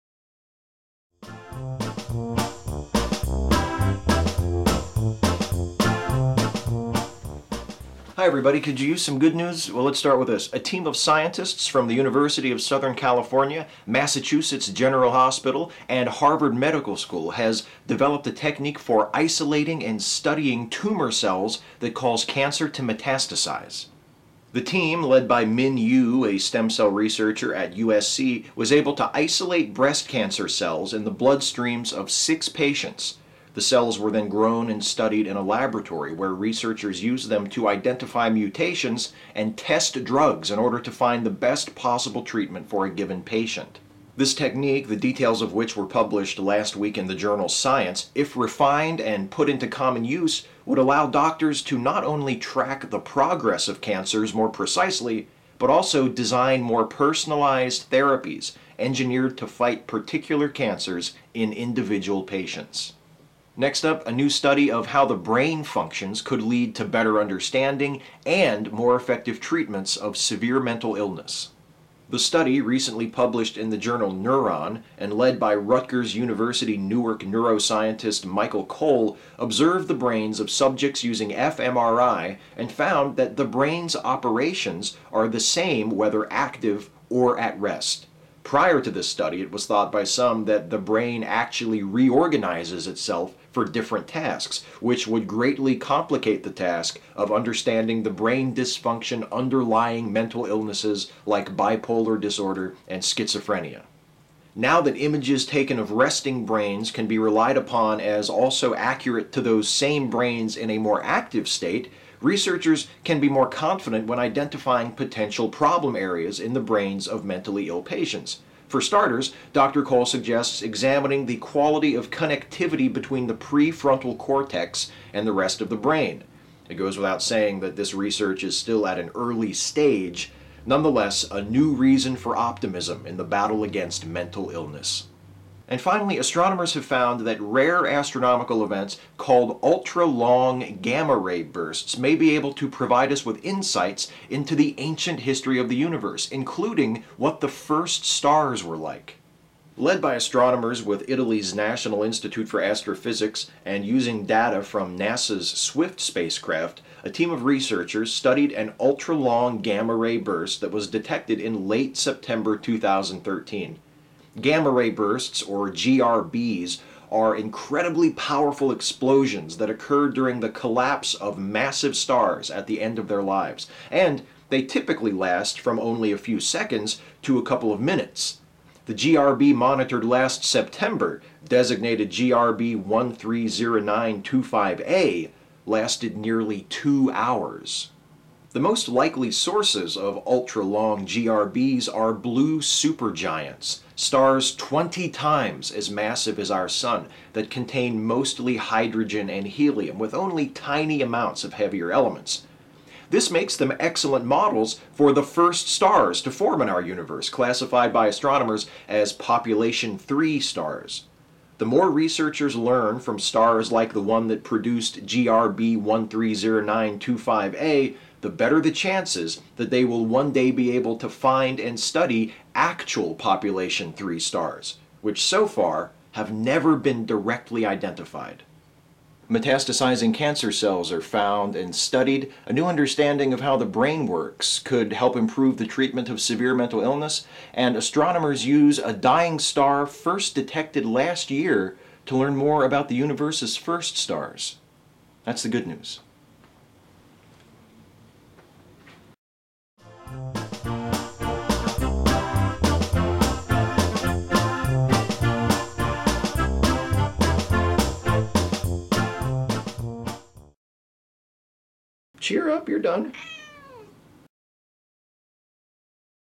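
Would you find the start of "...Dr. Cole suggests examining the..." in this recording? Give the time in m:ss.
1:59.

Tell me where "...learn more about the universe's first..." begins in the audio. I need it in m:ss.
4:02.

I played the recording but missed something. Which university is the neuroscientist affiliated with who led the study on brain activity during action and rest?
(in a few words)
Rutgers University Newark.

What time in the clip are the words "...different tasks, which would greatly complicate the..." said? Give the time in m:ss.
1:33.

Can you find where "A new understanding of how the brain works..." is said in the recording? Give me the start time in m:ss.
3:52.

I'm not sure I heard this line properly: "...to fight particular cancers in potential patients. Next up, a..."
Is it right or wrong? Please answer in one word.
wrong.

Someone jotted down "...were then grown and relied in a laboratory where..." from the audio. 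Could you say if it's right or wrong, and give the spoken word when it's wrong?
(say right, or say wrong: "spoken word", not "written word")
wrong: "studied", not "relied".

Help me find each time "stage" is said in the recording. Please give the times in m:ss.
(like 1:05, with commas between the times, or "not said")
2:09.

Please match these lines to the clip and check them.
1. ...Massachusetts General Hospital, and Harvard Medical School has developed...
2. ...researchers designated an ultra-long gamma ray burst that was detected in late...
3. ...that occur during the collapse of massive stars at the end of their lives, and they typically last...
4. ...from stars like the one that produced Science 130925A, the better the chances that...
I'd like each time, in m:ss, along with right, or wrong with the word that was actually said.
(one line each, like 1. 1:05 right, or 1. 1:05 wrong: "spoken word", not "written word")
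1. 0:13 right
2. 2:37 wrong: "studied", not "designated"
3. 2:49 right
4. 3:32 wrong: "GRB", not "Science".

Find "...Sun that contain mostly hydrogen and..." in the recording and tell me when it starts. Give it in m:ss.
3:16.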